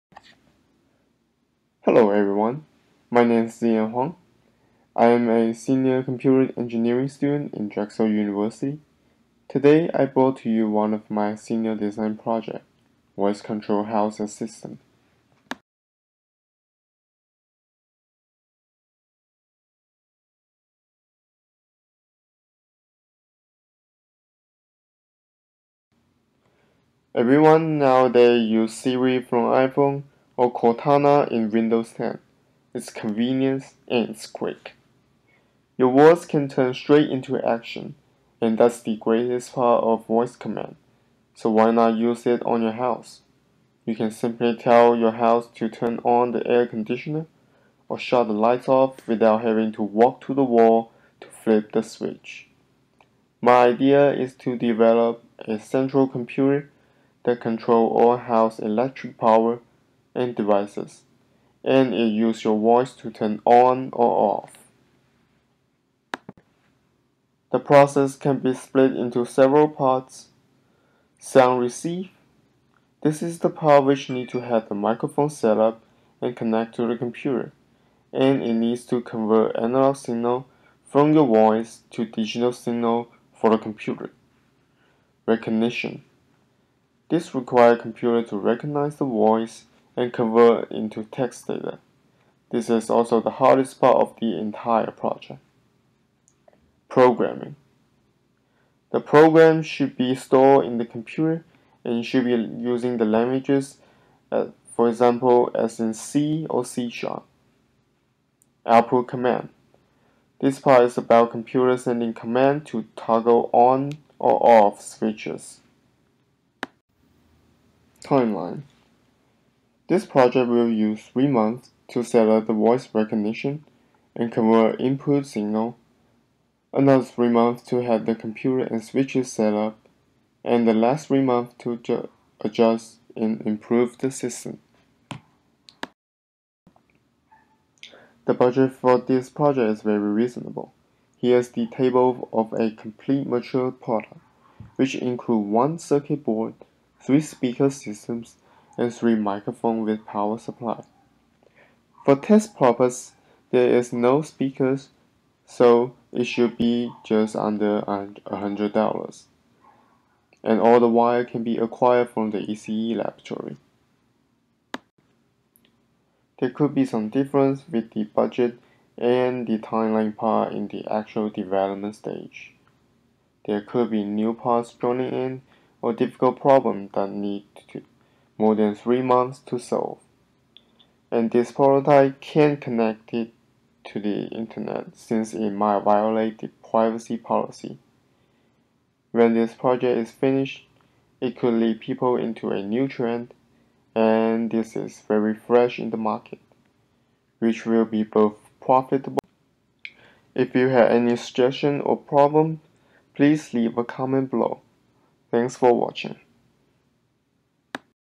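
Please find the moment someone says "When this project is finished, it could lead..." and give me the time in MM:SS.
03:09.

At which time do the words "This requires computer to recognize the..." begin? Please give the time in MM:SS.
01:27.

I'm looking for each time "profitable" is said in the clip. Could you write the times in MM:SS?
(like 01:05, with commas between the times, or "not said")
03:18.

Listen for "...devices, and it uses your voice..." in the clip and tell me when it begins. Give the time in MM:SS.
01:00.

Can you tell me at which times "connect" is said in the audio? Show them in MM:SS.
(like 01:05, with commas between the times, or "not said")
01:16, 03:02.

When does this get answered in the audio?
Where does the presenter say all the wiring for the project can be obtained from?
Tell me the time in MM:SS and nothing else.
02:42.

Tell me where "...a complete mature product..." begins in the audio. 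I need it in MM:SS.
02:22.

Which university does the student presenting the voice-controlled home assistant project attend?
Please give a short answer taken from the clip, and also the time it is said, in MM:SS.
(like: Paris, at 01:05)
Drexel University, at 00:07.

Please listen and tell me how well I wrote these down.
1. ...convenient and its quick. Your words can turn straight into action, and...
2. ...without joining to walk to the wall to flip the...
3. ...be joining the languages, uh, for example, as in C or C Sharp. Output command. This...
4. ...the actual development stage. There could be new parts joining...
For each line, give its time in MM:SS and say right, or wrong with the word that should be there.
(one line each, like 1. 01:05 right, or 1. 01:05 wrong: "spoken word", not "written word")
1. 00:32 right
2. 00:49 wrong: "having", not "joining"
3. 01:42 wrong: "using", not "joining"
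4. 02:50 right.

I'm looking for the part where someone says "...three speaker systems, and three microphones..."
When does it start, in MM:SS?
02:27.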